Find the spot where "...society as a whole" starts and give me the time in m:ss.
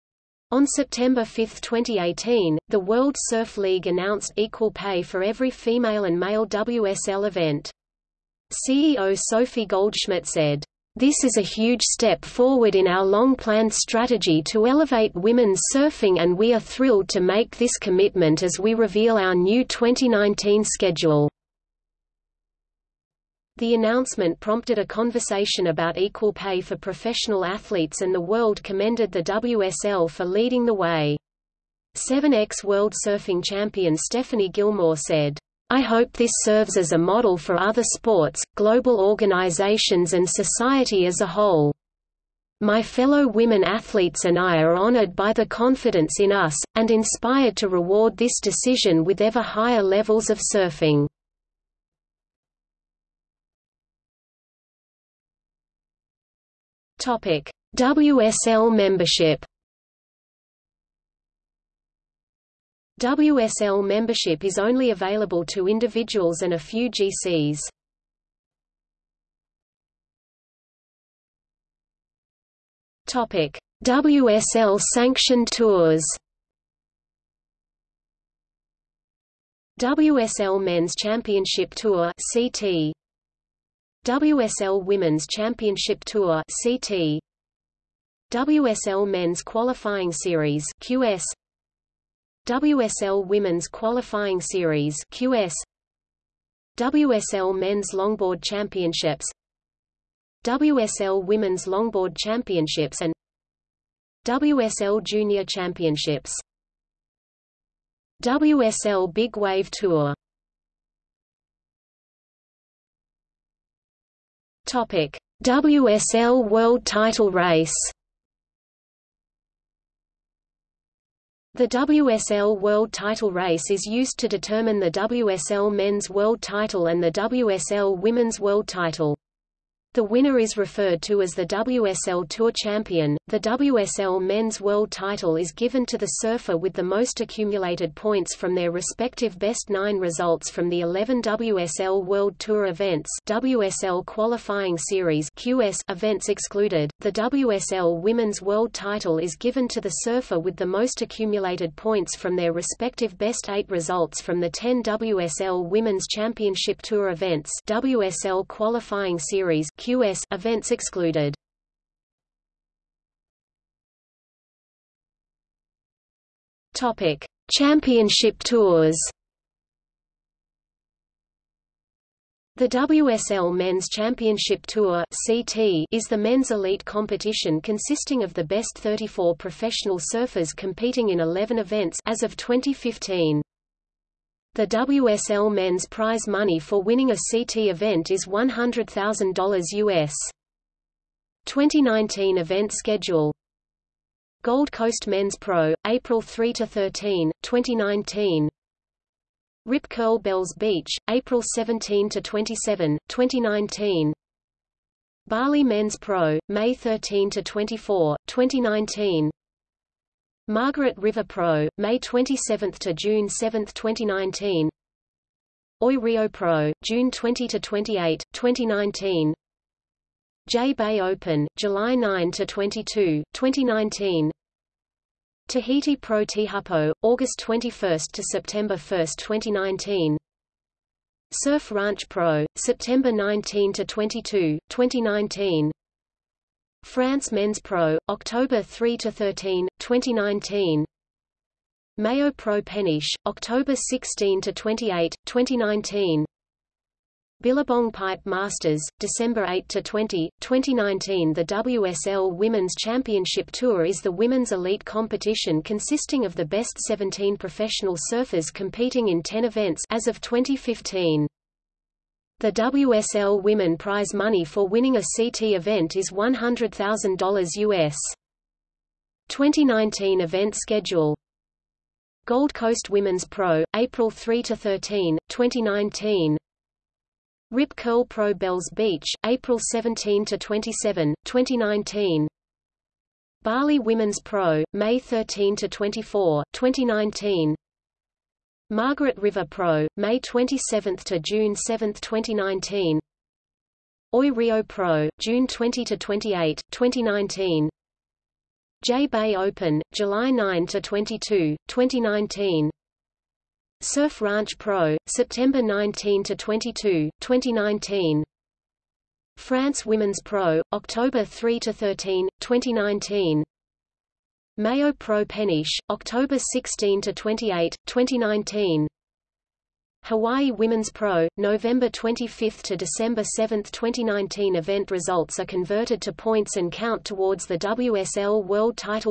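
0:40.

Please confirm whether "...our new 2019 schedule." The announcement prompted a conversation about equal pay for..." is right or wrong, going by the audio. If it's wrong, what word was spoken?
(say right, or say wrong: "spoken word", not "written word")
right.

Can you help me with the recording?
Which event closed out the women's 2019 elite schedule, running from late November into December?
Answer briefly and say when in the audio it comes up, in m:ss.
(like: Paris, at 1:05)
Hawaii Women's Pro, at 5:20.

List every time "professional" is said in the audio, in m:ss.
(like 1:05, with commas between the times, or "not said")
0:26, 2:59, 4:17.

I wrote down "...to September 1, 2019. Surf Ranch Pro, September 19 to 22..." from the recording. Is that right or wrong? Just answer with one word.
right.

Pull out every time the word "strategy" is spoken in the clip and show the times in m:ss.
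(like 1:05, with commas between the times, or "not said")
0:13.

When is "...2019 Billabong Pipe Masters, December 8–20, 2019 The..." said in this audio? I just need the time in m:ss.
4:05.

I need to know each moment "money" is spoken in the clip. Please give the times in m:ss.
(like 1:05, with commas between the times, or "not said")
3:06, 4:24.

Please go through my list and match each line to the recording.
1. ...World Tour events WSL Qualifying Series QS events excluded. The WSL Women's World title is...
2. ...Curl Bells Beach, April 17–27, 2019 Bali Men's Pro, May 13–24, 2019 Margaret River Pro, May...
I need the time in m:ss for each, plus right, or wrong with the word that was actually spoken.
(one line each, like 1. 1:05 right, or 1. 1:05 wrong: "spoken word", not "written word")
1. 2:22 right
2. 3:19 right.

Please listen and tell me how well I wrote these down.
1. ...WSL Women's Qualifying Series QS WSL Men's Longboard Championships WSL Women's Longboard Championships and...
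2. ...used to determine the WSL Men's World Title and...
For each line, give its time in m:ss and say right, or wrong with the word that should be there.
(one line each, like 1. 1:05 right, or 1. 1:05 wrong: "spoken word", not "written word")
1. 1:32 right
2. 2:03 right.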